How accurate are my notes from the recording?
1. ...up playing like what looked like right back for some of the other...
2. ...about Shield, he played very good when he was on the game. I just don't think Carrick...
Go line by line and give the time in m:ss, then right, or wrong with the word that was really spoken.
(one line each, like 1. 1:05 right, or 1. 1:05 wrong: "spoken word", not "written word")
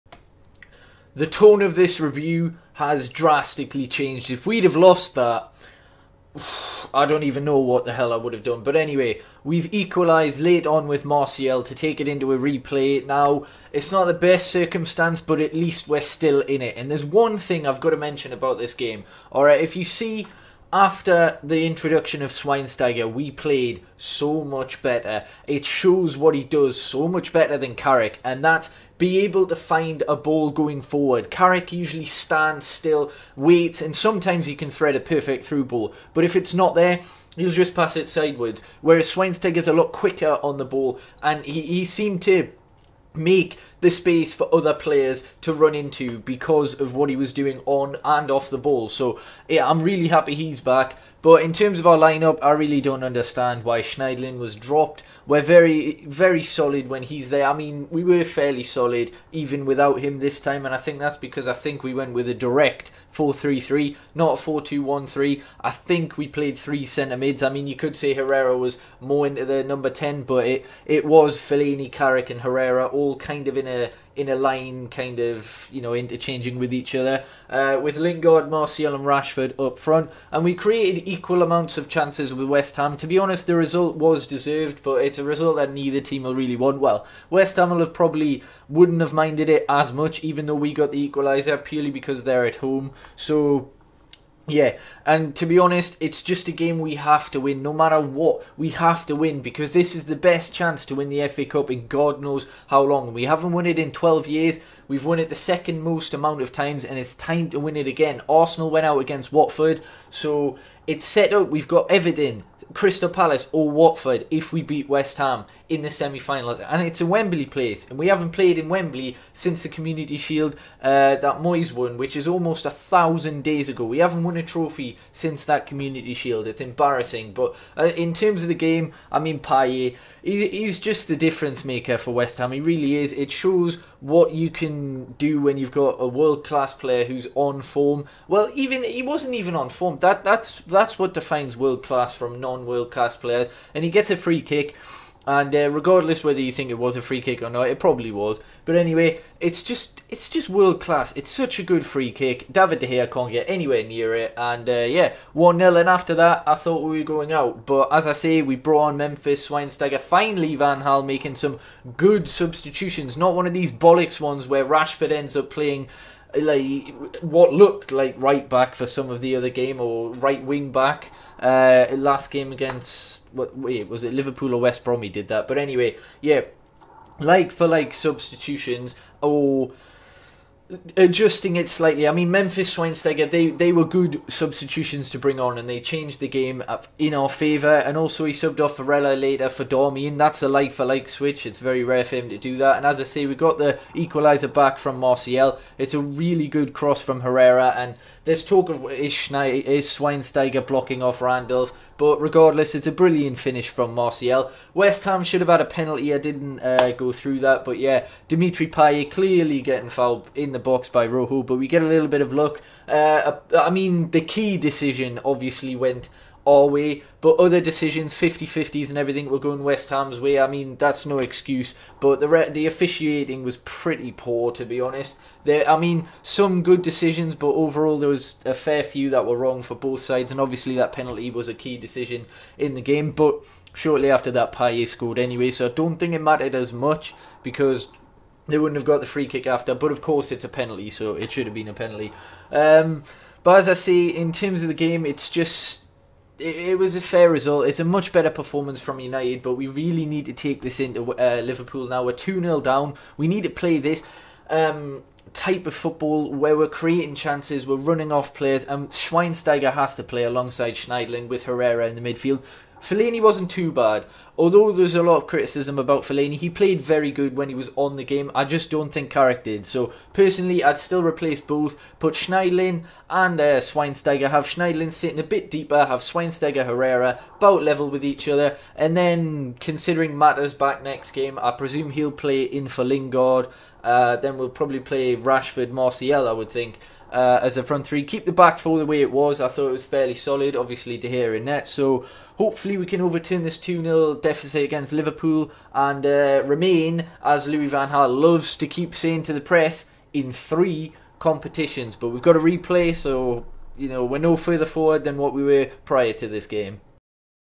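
1. 2:45 right
2. 4:25 wrong: "Fellaini", not "Shield".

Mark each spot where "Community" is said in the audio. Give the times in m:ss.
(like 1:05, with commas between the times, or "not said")
1:59, 2:05.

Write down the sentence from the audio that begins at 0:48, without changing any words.
So yeah, I'm really happy he's back.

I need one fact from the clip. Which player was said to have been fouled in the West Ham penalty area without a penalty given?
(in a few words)
Rojo.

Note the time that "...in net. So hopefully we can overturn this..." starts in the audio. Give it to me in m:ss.
4:51.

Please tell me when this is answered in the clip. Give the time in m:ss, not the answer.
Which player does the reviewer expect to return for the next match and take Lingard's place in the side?
4:40.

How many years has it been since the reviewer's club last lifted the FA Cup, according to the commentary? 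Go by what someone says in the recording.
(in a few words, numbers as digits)
12.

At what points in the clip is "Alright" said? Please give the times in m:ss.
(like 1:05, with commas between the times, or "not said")
0:19.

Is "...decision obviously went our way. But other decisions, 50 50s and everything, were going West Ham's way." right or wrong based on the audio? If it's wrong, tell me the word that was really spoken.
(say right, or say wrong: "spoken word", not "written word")
right.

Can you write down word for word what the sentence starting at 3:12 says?
And as I say, we got the equaliser back from Martial.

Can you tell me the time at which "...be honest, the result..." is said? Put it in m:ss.
1:23.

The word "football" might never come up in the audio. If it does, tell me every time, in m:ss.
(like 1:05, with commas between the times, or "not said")
4:15.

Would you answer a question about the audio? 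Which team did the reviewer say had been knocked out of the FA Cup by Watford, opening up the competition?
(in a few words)
Arsenal.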